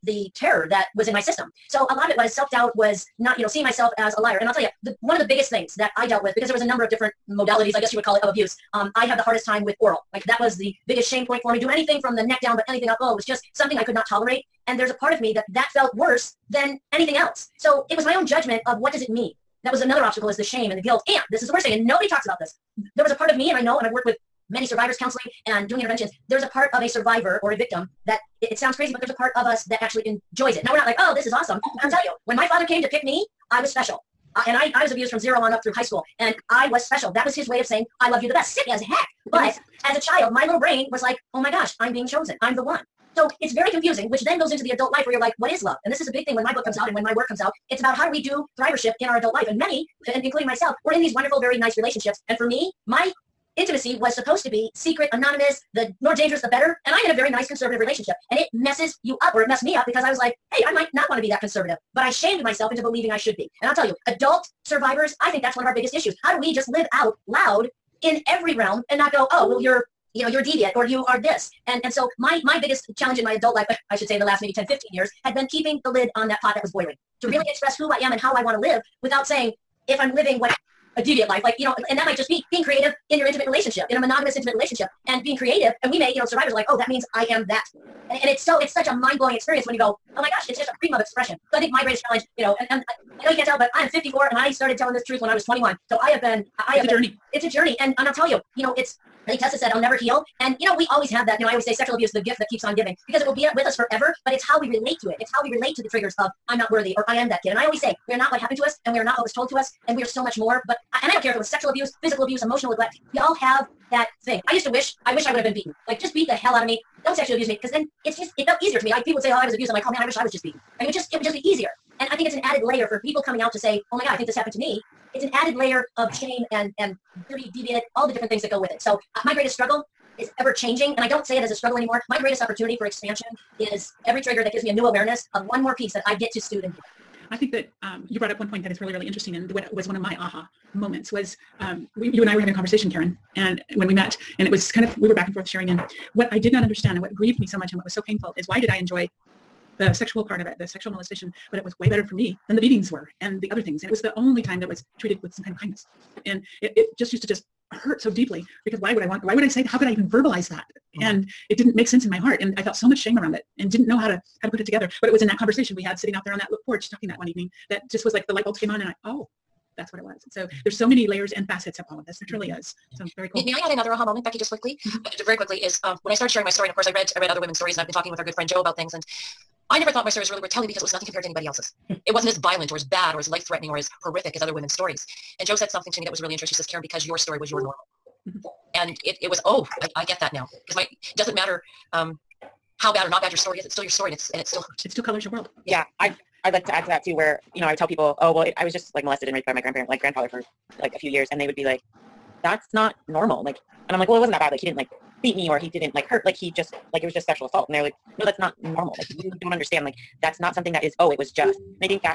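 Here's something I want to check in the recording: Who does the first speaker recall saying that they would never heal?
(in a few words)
Tessa.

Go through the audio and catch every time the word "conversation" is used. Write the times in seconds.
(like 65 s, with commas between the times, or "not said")
142 s, 165 s.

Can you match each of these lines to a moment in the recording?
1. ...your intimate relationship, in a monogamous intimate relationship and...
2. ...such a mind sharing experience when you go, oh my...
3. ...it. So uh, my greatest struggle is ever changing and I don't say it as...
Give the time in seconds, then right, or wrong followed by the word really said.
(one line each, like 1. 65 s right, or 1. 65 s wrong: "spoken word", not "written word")
1. 83 s right
2. 88 s wrong: "blowing", not "sharing"
3. 128 s right.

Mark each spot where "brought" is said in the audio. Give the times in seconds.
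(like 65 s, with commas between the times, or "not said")
138 s.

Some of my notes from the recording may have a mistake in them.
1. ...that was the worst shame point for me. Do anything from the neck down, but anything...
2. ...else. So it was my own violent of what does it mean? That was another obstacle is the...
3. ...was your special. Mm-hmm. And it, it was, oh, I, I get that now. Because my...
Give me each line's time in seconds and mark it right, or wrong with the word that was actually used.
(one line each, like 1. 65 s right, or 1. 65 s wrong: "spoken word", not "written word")
1. 10 s wrong: "biggest", not "worst"
2. 17 s wrong: "judgment", not "violent"
3. 187 s wrong: "normal", not "special".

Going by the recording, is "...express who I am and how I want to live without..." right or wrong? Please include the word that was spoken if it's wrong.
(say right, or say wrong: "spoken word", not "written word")
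right.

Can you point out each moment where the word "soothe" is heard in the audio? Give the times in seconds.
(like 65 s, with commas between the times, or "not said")
136 s.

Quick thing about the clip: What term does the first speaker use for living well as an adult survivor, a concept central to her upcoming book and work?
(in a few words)
thrivership.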